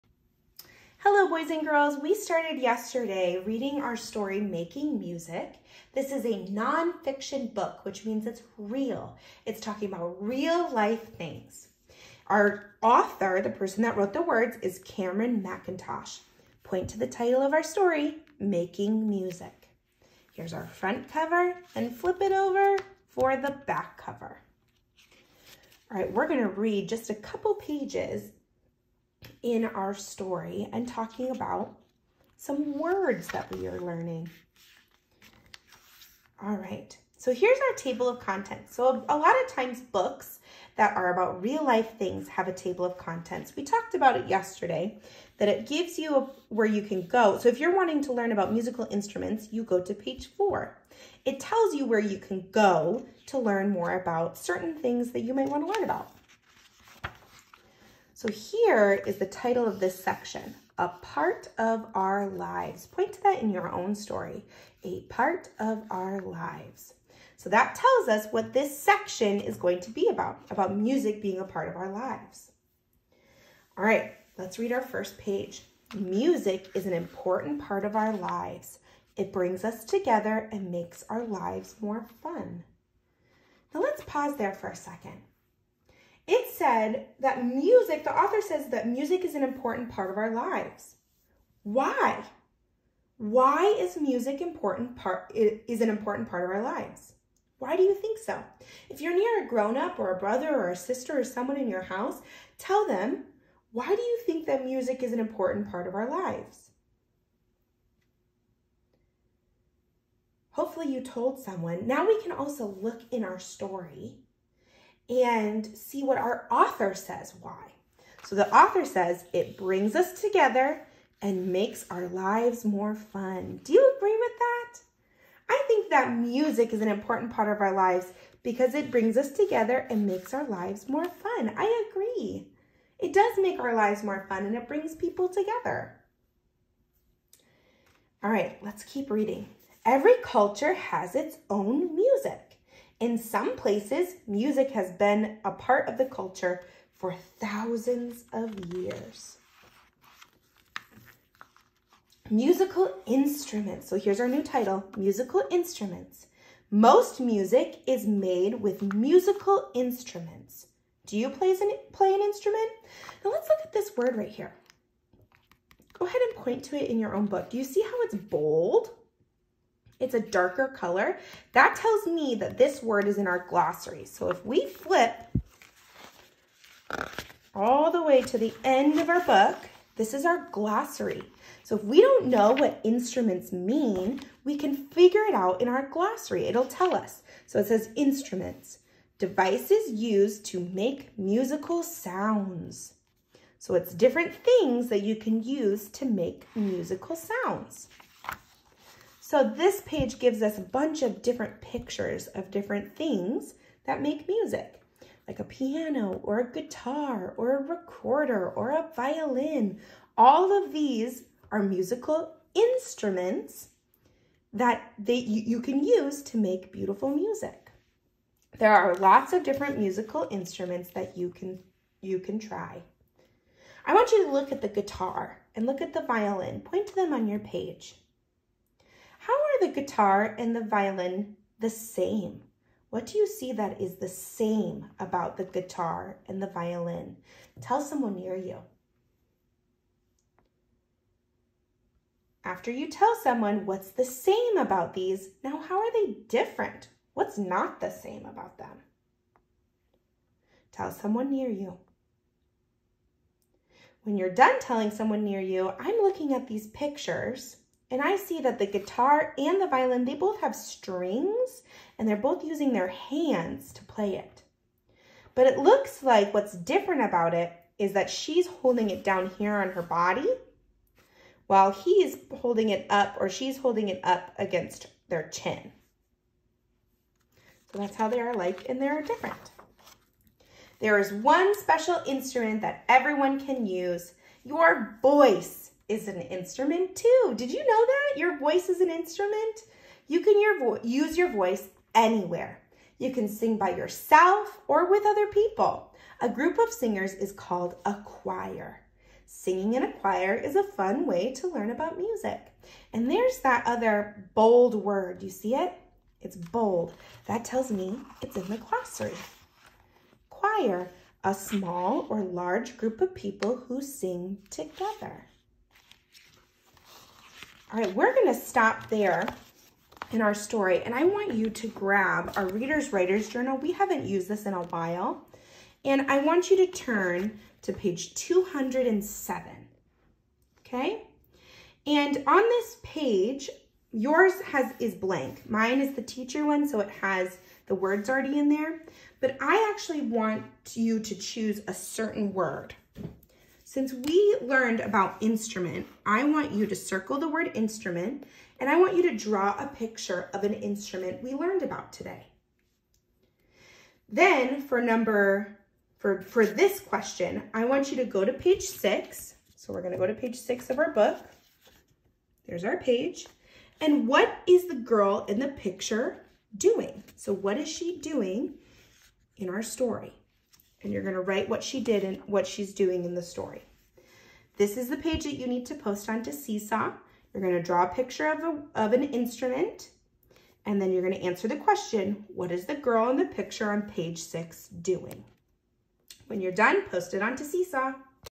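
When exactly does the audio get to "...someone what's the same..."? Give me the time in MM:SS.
04:03.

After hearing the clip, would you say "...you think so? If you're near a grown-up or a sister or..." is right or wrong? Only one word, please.
wrong.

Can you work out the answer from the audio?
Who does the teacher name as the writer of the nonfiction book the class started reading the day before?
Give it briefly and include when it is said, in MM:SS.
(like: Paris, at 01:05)
Cameron McIntosh, at 00:14.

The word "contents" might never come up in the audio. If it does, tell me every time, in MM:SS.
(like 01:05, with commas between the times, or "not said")
00:38, 00:42.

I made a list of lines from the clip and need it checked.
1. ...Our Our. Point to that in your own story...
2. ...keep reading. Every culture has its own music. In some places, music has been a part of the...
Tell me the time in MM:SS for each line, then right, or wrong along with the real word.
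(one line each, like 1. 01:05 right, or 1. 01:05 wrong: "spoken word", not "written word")
1. 01:01 wrong: "Lives", not "Our"
2. 02:18 right.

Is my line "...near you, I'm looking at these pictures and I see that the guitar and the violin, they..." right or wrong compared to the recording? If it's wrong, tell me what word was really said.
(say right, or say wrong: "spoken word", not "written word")
right.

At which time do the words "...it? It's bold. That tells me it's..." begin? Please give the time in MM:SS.
05:05.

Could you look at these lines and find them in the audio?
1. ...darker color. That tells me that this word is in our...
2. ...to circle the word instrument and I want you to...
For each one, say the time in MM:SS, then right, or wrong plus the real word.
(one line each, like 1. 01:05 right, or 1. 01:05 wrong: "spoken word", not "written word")
1. 02:50 right
2. 05:46 right.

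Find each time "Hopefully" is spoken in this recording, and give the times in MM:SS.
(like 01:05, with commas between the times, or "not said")
01:50.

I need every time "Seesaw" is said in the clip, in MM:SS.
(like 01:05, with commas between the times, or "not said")
06:16, 06:27.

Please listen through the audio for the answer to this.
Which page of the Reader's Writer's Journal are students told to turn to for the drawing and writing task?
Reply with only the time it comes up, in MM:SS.
05:27.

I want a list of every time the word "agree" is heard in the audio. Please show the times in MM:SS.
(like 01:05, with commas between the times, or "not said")
02:03, 02:11.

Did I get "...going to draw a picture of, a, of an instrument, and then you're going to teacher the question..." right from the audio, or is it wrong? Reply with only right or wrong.
wrong.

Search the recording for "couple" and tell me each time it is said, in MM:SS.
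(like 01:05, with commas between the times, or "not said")
00:27.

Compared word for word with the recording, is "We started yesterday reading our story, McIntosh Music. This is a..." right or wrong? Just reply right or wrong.
wrong.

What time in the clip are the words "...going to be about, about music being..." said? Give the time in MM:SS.
01:09.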